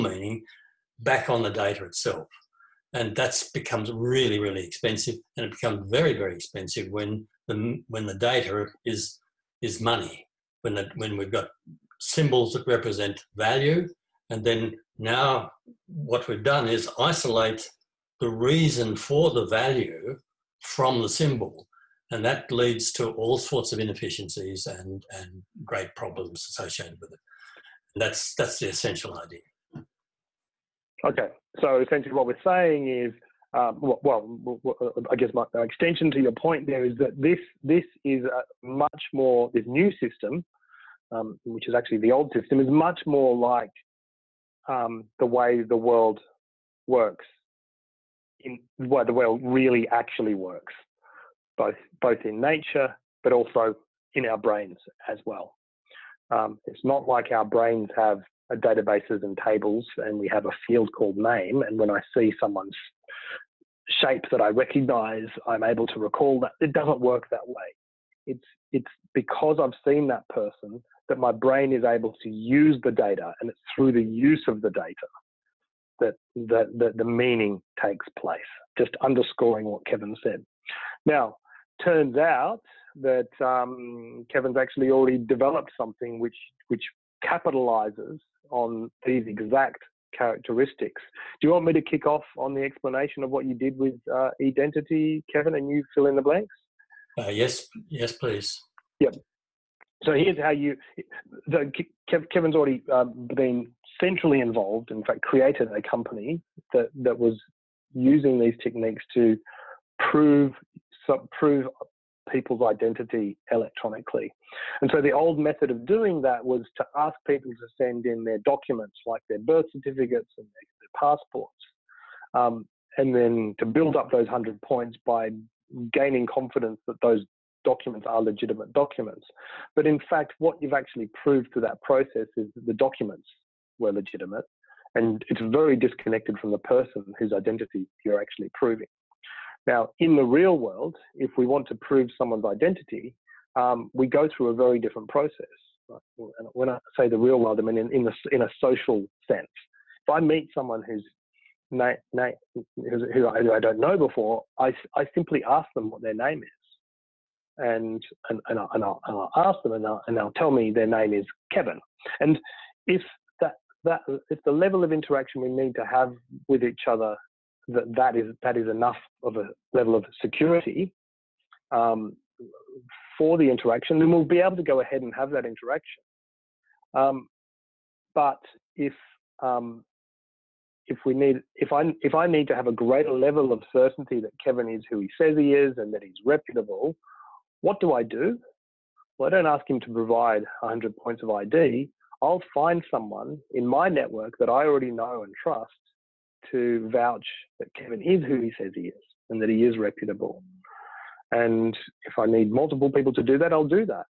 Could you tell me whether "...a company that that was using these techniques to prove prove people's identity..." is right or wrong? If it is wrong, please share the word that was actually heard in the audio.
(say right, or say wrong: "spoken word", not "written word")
right.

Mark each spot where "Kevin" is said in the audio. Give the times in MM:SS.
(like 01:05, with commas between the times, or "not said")
01:19, 01:24, 01:35, 01:42, 02:41, 03:04, 03:17.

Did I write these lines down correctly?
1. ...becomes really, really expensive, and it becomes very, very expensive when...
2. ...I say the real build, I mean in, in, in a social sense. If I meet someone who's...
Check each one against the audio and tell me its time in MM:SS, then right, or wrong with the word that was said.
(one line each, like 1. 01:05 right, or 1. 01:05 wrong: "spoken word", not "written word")
1. 00:03 right
2. 02:26 wrong: "world", not "build".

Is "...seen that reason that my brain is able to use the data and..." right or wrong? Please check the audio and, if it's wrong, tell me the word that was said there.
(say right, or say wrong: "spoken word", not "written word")
wrong: "person", not "reason".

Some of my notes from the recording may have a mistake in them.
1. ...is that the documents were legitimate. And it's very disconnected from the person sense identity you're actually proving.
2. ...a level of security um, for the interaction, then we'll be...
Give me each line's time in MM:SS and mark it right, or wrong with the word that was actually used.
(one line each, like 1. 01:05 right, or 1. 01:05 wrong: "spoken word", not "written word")
1. 02:12 wrong: "whose", not "sense"
2. 02:49 right.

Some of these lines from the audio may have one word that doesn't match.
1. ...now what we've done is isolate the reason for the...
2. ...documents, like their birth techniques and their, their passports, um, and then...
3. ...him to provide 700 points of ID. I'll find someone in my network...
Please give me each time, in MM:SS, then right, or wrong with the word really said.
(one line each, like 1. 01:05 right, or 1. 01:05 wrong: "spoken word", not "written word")
1. 00:14 right
2. 01:58 wrong: "certificates", not "techniques"
3. 03:09 wrong: "100", not "700".